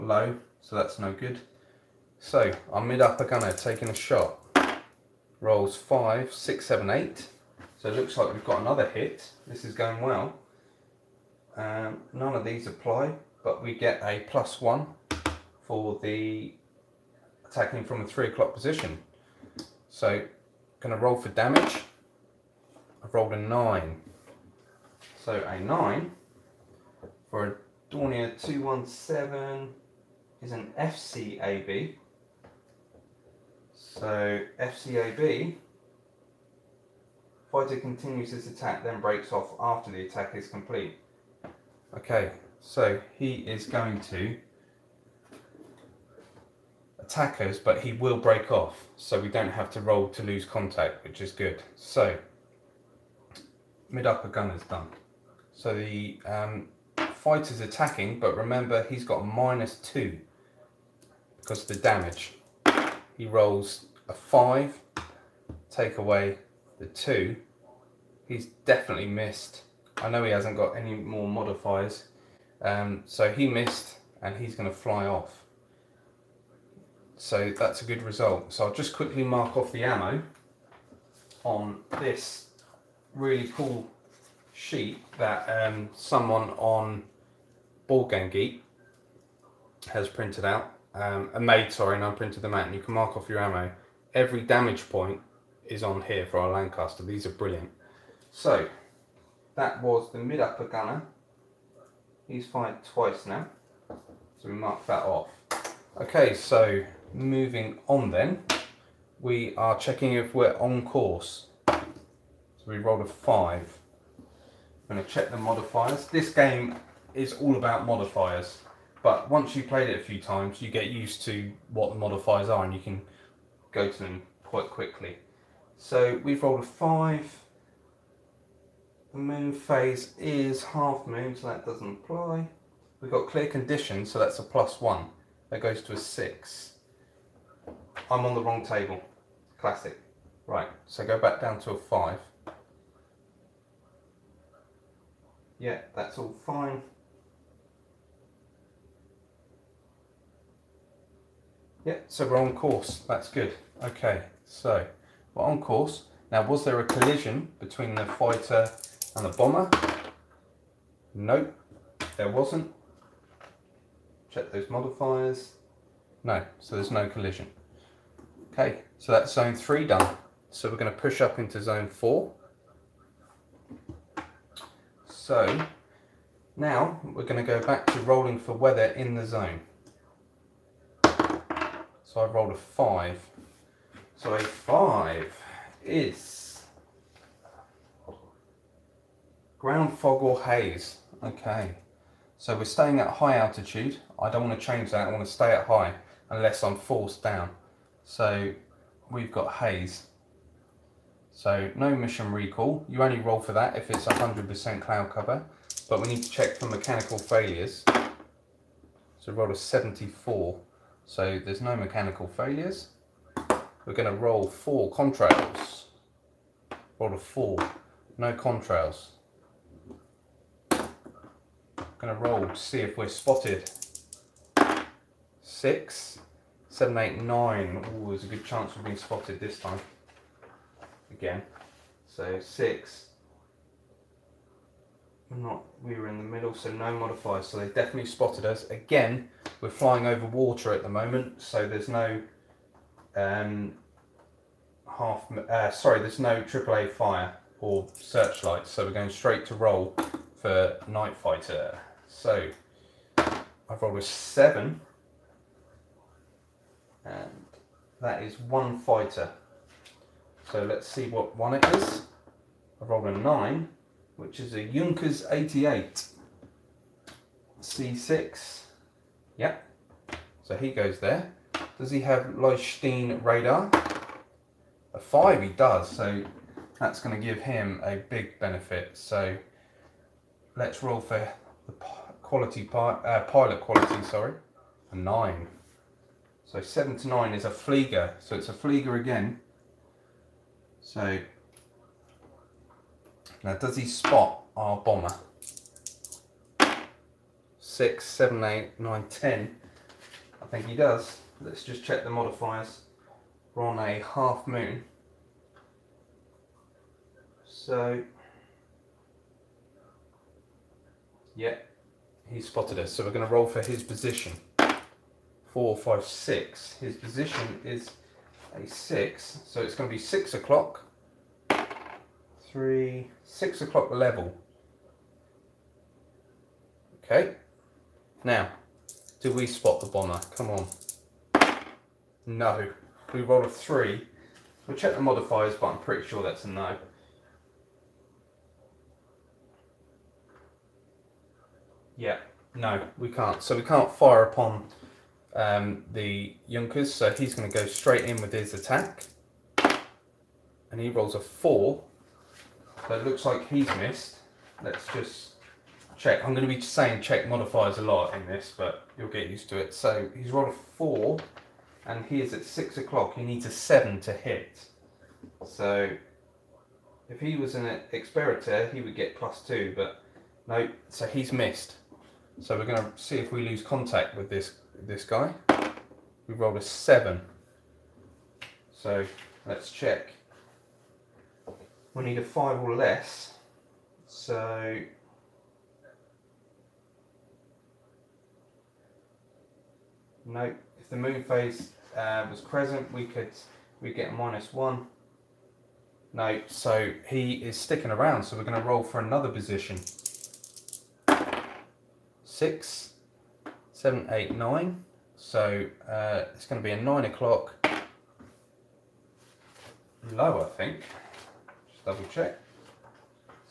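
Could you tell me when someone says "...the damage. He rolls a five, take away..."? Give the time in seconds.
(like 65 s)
61 s.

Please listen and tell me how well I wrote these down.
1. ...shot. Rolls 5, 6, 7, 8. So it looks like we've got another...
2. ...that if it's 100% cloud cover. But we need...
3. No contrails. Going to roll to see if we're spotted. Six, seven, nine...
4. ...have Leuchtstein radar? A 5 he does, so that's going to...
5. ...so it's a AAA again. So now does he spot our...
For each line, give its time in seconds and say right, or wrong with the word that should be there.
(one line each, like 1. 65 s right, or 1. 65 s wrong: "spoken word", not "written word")
1. 3 s right
2. 203 s right
3. 218 s wrong: "eight", not "nine"
4. 272 s right
5. 288 s wrong: "Flieger", not "AAA".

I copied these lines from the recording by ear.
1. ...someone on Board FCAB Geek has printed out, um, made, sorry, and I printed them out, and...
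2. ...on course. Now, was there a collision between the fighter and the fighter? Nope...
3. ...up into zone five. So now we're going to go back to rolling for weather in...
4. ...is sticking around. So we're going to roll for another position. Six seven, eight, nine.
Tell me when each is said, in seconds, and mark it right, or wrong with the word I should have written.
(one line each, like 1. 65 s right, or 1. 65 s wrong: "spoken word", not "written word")
1. 85 s wrong: "Game", not "FCAB"
2. 155 s wrong: "bomber", not "fighter"
3. 171 s wrong: "four", not "five"
4. 397 s right.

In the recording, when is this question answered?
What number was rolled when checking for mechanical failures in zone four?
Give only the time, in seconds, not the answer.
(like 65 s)
209 s.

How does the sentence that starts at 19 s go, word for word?
So, going to roll for damage.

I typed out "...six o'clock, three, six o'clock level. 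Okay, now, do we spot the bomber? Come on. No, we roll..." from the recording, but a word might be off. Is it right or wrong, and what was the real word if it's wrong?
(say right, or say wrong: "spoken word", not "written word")
right.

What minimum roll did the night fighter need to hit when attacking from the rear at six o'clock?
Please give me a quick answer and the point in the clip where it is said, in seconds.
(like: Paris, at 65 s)
7, at 363 s.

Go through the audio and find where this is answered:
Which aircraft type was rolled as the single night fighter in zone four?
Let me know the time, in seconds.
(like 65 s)
264 s.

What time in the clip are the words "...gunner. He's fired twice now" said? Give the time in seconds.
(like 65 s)
100 s.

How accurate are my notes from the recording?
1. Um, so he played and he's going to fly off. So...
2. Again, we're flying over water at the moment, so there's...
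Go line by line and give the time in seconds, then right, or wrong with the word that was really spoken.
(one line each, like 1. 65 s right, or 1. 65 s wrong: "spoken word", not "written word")
1. 72 s wrong: "missed", not "played"
2. 238 s right.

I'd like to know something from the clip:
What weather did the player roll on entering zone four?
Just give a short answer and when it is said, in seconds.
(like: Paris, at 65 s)
Ground fog or haze, at 189 s.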